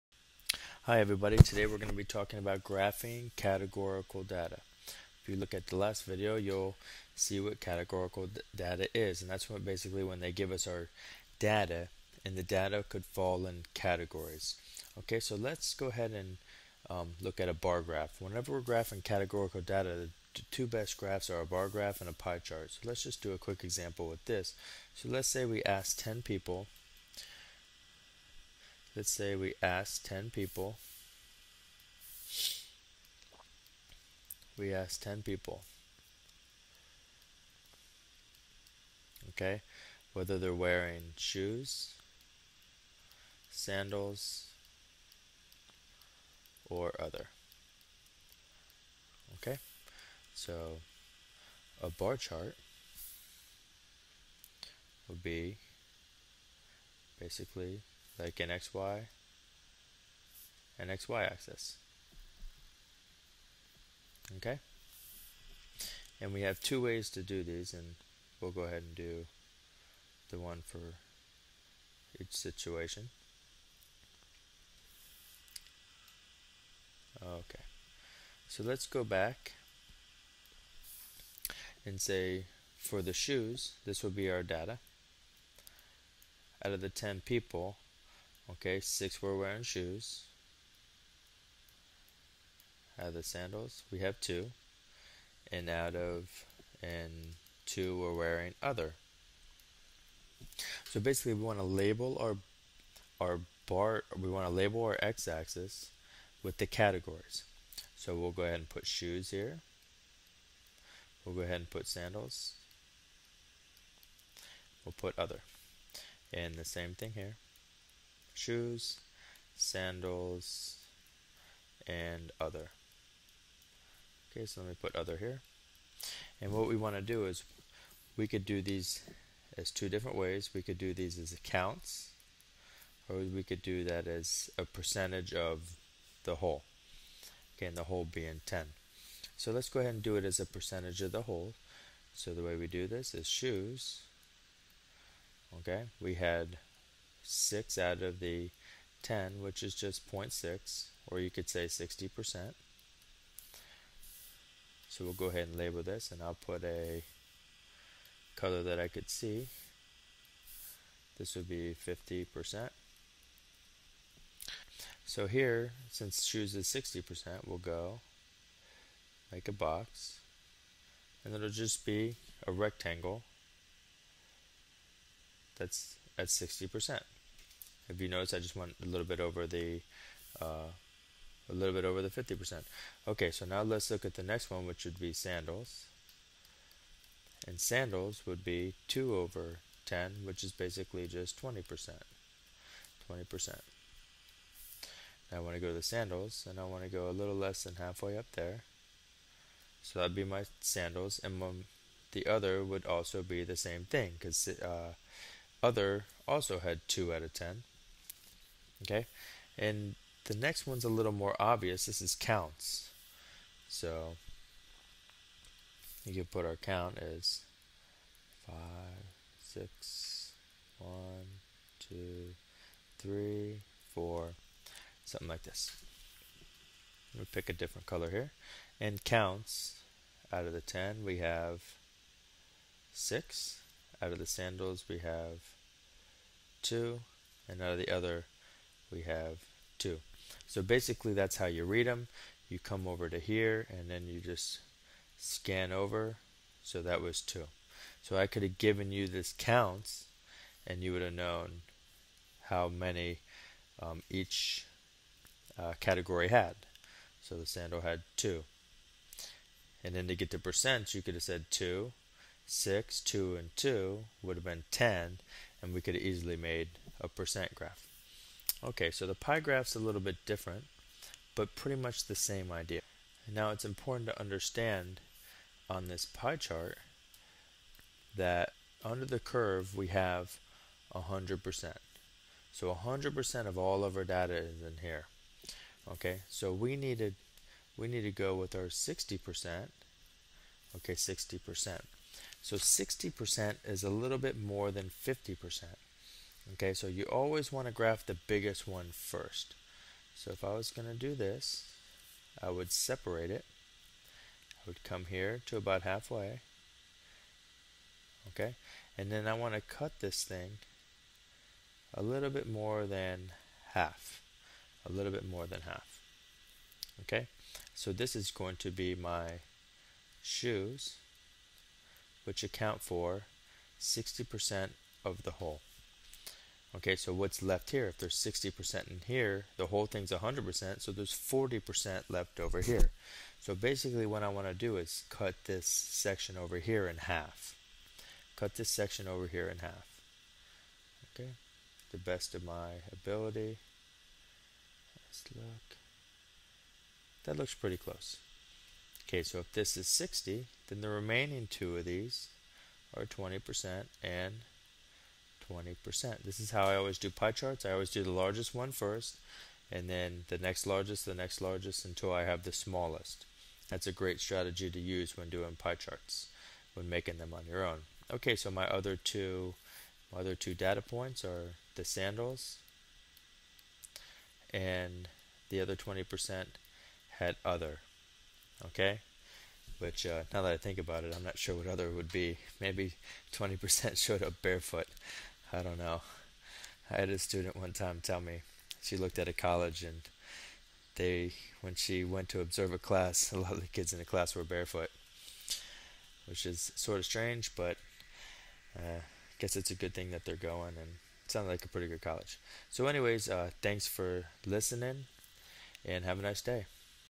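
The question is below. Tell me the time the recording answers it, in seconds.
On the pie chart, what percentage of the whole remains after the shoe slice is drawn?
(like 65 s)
331 s.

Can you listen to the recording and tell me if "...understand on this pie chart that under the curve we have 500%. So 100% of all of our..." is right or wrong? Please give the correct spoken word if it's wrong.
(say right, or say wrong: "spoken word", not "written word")
wrong: "100", not "500".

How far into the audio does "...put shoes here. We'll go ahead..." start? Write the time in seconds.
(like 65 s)
108 s.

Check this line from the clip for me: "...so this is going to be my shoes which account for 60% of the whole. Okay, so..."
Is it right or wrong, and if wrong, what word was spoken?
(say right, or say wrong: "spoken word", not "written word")
right.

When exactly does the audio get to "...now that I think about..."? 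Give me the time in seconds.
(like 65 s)
380 s.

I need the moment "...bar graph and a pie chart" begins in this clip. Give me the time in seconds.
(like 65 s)
21 s.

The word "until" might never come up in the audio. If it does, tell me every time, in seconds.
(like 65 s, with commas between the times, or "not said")
361 s.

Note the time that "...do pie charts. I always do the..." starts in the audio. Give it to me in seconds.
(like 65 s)
356 s.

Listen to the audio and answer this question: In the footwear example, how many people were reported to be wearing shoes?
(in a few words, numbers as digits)
6.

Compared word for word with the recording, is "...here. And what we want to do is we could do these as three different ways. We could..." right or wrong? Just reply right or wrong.
wrong.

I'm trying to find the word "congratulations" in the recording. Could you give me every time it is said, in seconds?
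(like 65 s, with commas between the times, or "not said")
not said.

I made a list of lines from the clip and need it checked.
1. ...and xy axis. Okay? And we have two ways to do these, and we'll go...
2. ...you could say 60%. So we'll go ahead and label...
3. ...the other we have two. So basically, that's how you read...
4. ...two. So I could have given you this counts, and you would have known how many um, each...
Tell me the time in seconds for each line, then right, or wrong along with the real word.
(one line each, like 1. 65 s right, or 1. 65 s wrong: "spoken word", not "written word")
1. 60 s right
2. 151 s right
3. 237 s right
4. 247 s right.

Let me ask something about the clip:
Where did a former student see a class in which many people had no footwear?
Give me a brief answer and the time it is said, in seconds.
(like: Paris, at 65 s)
a college, at 389 s.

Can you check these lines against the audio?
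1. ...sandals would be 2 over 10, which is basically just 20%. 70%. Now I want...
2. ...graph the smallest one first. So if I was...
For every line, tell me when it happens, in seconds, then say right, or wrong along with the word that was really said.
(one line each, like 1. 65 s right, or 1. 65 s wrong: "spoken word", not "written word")
1. 187 s wrong: "20", not "70"
2. 297 s wrong: "biggest", not "smallest".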